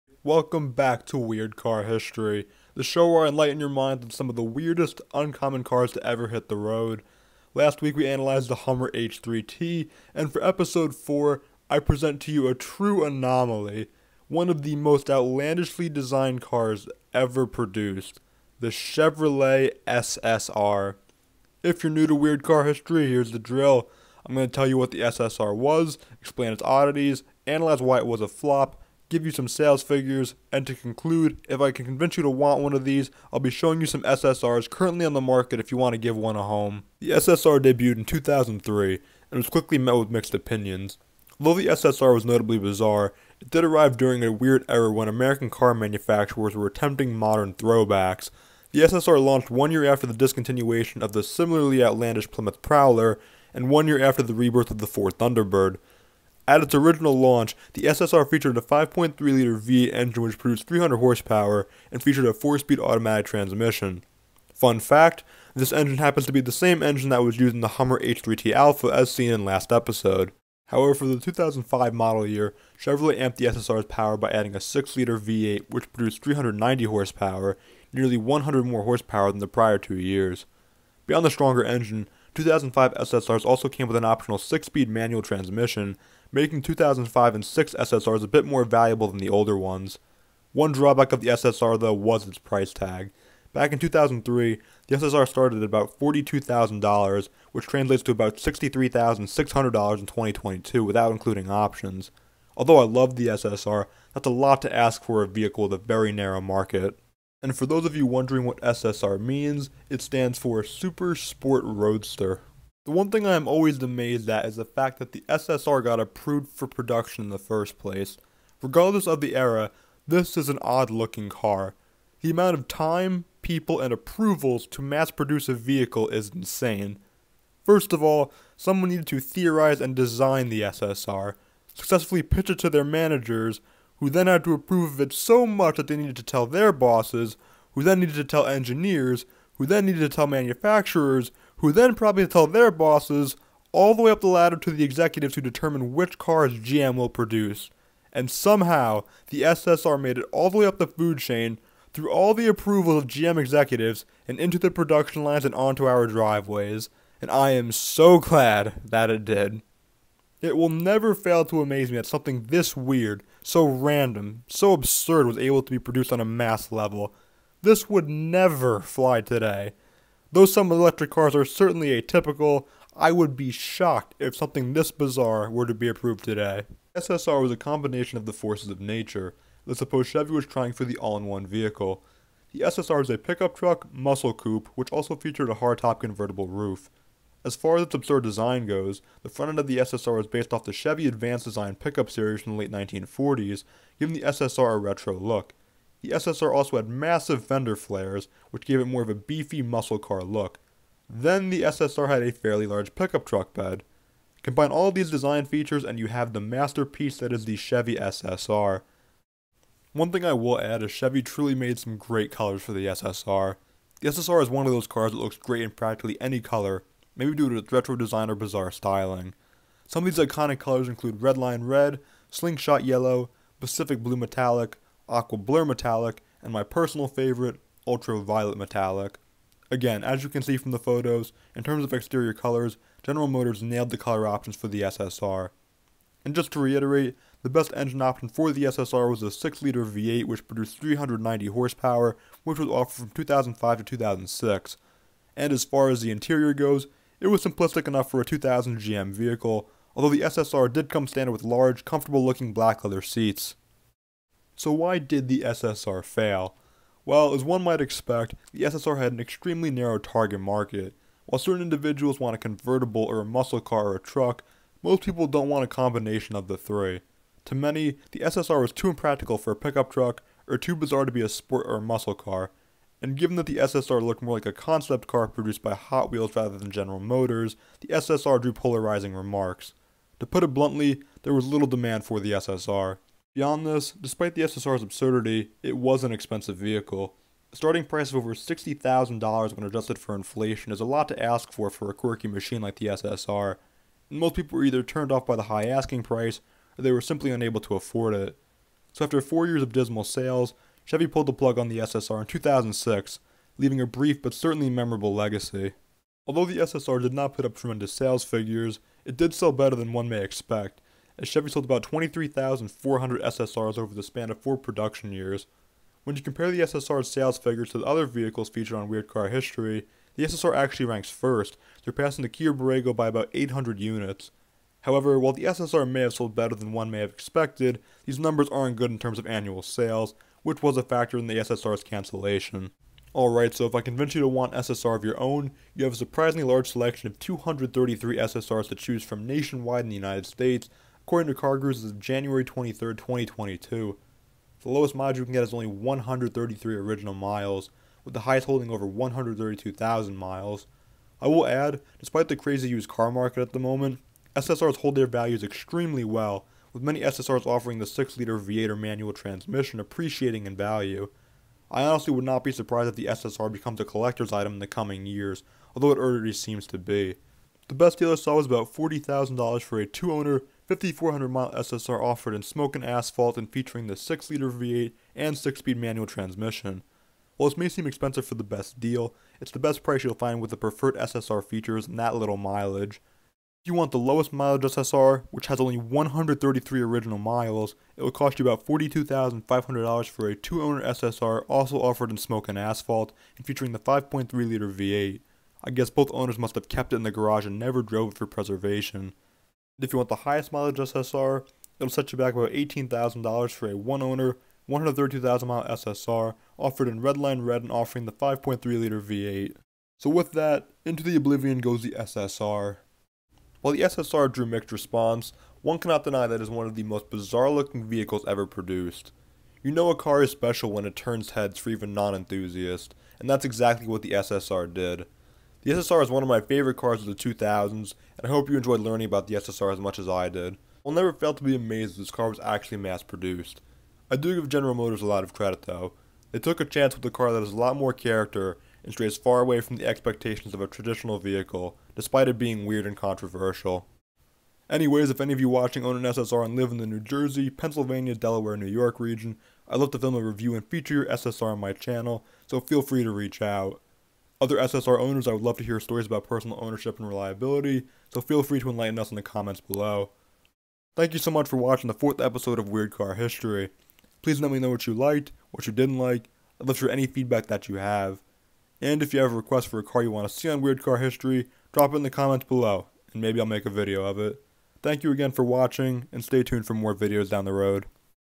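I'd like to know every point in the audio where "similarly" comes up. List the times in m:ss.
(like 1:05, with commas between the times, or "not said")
0:51.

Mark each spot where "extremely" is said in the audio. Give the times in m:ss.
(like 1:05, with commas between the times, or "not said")
4:19, 5:55.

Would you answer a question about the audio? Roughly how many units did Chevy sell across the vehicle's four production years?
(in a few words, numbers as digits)
23,400.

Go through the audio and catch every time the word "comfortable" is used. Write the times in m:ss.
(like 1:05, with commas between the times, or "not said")
4:11.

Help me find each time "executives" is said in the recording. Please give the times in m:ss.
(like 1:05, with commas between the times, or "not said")
2:24, 2:33.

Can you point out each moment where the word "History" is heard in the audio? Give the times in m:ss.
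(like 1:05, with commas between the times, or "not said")
0:01, 0:22, 5:19, 7:43, 7:50.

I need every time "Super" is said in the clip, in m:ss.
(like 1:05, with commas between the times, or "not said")
1:50.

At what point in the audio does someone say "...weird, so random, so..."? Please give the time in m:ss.
2:42.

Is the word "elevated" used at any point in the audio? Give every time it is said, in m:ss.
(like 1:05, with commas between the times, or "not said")
not said.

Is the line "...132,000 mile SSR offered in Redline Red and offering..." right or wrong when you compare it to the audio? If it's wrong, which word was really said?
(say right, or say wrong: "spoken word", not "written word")
right.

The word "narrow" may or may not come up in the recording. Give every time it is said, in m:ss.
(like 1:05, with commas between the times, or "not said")
1:46, 4:19.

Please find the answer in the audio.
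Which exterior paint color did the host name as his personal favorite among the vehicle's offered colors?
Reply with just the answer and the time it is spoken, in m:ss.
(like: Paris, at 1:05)
Ultraviolet Metallic, at 3:47.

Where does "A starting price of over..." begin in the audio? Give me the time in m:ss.
4:47.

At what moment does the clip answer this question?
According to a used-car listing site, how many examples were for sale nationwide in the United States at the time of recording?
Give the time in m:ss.
5:37.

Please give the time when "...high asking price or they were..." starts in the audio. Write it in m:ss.
4:55.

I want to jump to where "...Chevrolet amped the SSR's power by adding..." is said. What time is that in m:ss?
1:12.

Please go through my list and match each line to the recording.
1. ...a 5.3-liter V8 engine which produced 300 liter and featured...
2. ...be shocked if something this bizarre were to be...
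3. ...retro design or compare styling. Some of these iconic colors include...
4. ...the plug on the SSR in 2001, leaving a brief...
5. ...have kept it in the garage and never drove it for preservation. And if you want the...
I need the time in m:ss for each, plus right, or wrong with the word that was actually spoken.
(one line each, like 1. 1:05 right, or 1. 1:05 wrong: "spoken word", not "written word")
1. 0:58 wrong: "horsepower", not "liter"
2. 2:53 right
3. 3:37 wrong: "bizarre", not "compare"
4. 5:01 wrong: "2006", not "2001"
5. 6:36 right.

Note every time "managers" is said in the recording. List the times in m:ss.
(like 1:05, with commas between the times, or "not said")
2:12.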